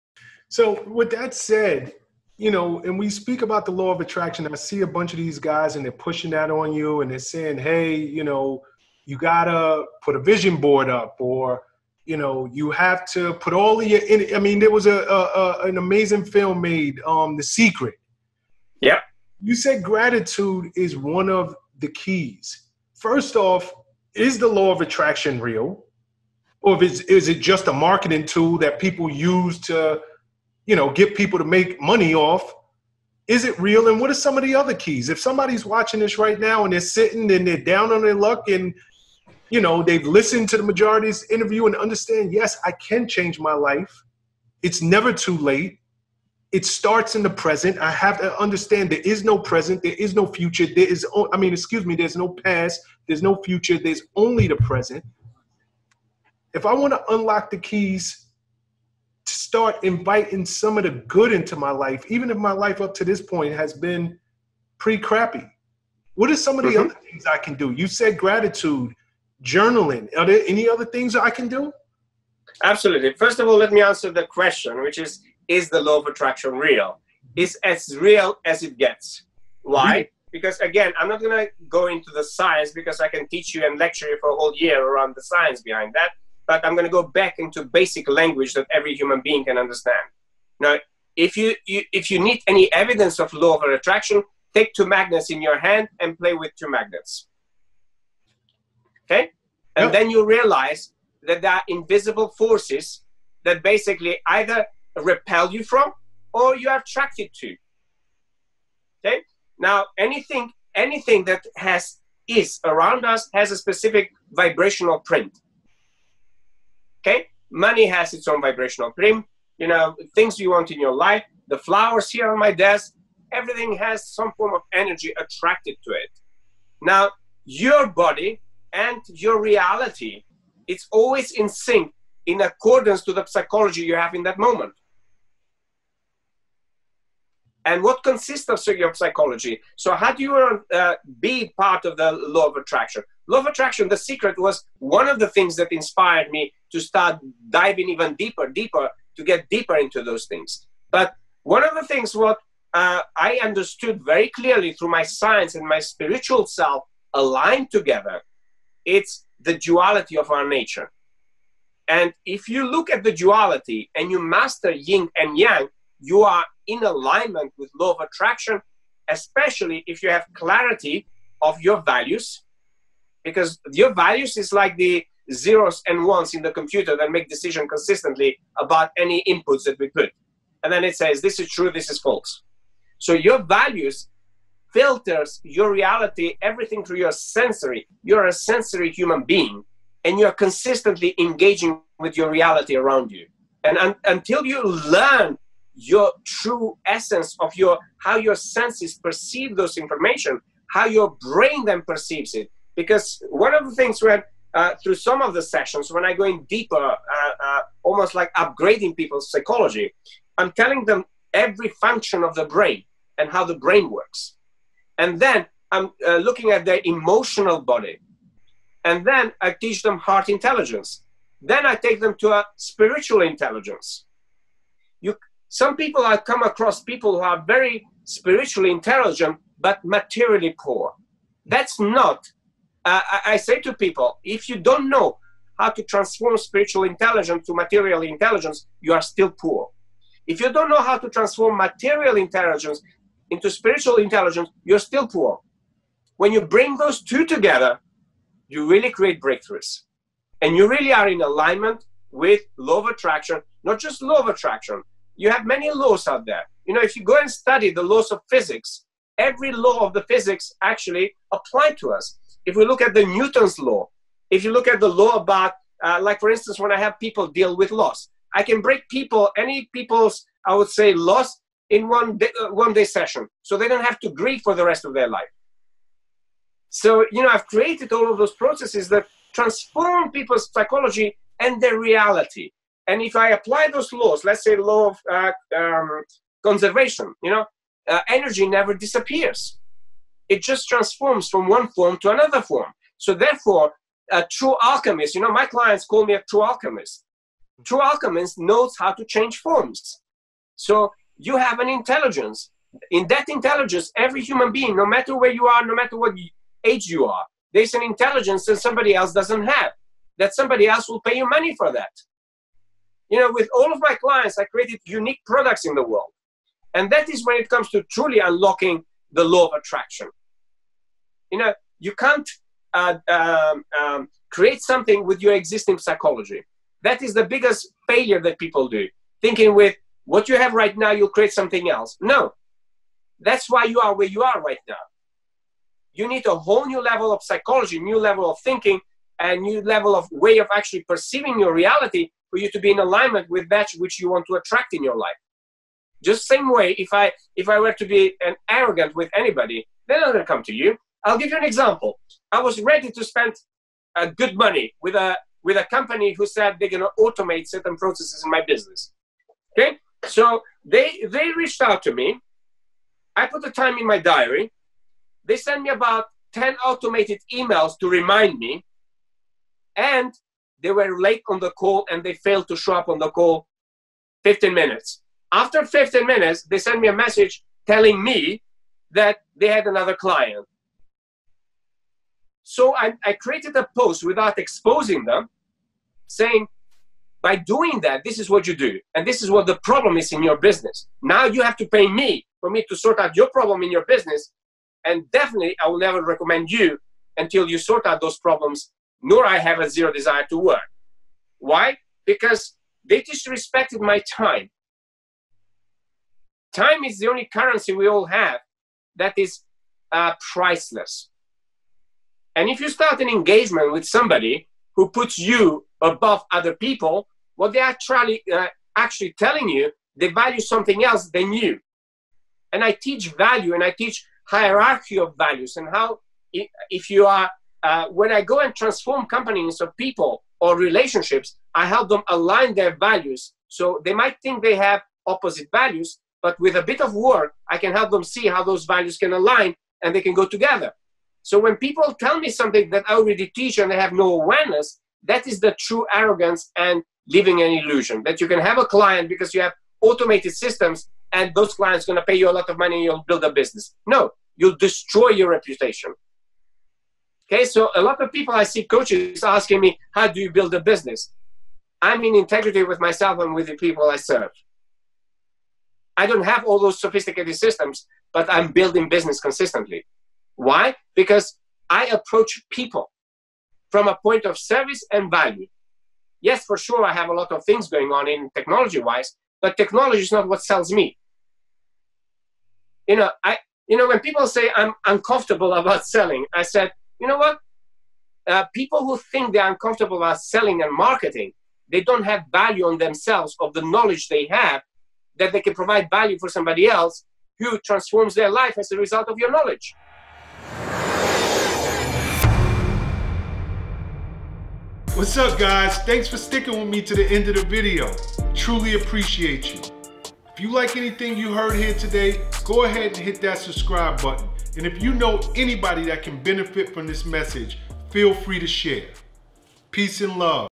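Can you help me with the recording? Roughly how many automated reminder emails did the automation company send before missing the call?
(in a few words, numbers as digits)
10.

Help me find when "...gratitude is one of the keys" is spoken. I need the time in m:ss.
0:19.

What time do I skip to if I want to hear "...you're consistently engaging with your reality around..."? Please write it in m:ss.
3:10.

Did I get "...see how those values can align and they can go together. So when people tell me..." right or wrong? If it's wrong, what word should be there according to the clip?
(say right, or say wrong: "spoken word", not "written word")
right.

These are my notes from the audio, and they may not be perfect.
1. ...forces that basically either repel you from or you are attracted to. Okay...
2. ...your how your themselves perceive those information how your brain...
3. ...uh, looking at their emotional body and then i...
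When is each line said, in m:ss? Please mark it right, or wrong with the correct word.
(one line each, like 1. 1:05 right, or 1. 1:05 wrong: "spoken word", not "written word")
1. 1:42 right
2. 3:17 wrong: "senses", not "themselves"
3. 3:36 right.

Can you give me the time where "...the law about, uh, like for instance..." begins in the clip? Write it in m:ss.
4:24.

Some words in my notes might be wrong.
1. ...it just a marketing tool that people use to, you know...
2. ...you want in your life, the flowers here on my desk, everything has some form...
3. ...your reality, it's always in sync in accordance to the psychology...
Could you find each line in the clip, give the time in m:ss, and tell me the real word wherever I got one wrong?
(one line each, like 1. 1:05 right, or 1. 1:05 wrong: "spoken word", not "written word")
1. 0:27 right
2. 2:00 right
3. 2:09 right.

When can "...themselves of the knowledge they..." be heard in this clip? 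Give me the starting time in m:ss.
8:12.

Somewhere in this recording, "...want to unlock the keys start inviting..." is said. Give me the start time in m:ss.
0:56.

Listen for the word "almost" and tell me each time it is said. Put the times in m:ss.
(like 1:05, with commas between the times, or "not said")
3:27.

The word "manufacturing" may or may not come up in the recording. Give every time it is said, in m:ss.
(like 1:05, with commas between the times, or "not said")
not said.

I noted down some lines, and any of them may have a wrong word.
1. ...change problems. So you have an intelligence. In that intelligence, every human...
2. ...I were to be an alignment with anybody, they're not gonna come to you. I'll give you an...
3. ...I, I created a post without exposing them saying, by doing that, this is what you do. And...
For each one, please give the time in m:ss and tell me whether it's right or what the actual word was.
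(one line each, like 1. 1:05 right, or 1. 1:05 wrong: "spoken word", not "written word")
1. 4:59 wrong: "forms", not "problems"
2. 5:47 wrong: "arrogant", not "alignment"
3. 6:22 right.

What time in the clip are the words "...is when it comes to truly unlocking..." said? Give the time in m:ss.
5:17.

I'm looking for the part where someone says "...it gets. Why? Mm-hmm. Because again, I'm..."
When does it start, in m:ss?
1:18.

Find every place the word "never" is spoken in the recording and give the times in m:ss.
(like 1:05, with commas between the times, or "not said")
0:44, 4:48, 6:35.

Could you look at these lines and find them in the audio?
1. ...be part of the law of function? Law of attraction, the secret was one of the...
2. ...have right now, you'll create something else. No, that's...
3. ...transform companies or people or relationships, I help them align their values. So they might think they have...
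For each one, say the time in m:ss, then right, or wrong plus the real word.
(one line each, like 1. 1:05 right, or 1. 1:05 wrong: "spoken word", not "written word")
1. 2:21 wrong: "attraction", not "function"
2. 5:30 right
3. 7:08 right.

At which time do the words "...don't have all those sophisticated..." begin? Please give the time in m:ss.
7:46.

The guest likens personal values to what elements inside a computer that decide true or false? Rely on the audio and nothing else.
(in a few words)
Zeros and ones.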